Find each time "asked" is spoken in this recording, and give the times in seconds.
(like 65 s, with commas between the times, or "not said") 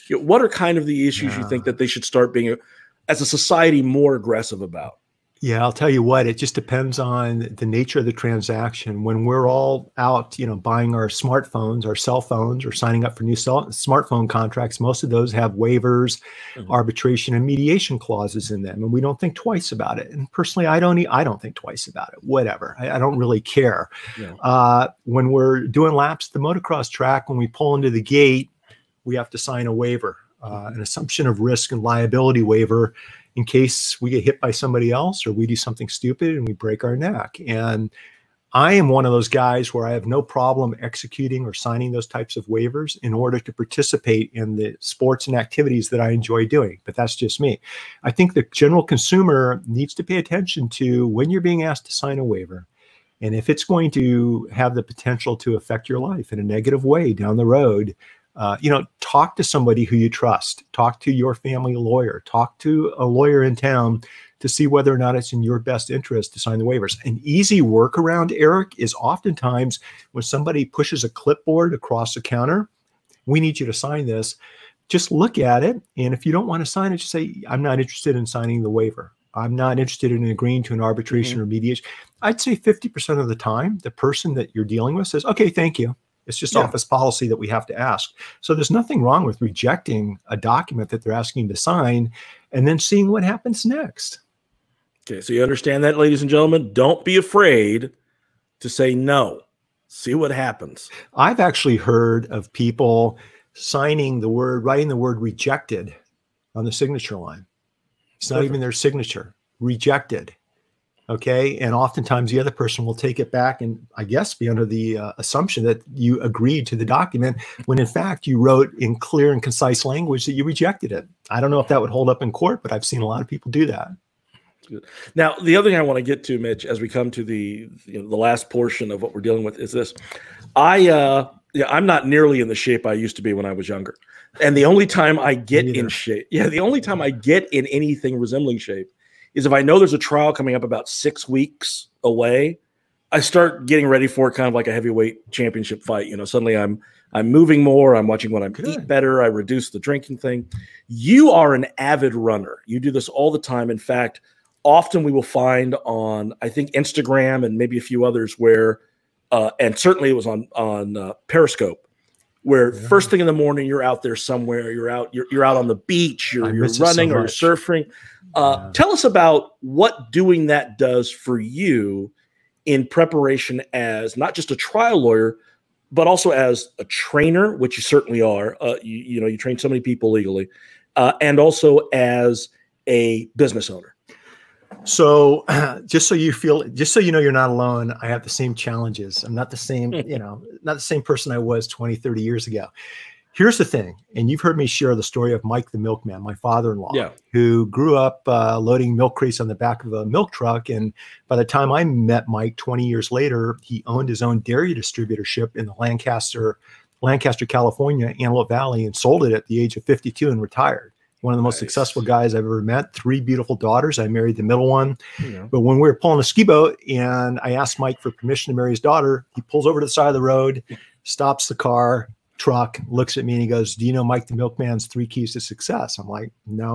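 51 s, 217 s.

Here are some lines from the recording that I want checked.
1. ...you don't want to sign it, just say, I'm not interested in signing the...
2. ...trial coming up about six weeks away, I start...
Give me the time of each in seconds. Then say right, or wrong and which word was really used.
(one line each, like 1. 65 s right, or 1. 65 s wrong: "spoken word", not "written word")
1. 76 s right
2. 139 s right.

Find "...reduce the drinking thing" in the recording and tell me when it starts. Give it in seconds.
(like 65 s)
149 s.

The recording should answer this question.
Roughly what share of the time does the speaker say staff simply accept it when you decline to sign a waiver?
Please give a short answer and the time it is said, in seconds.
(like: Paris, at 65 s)
50%, at 82 s.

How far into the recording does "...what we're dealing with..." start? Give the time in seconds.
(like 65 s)
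129 s.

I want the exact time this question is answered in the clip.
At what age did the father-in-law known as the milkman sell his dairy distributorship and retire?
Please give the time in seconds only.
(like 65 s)
209 s.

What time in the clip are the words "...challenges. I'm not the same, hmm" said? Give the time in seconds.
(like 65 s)
188 s.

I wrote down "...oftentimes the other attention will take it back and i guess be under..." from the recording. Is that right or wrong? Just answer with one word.
wrong.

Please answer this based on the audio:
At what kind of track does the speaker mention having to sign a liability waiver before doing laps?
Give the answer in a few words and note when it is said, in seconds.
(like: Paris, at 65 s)
Motocross track, at 26 s.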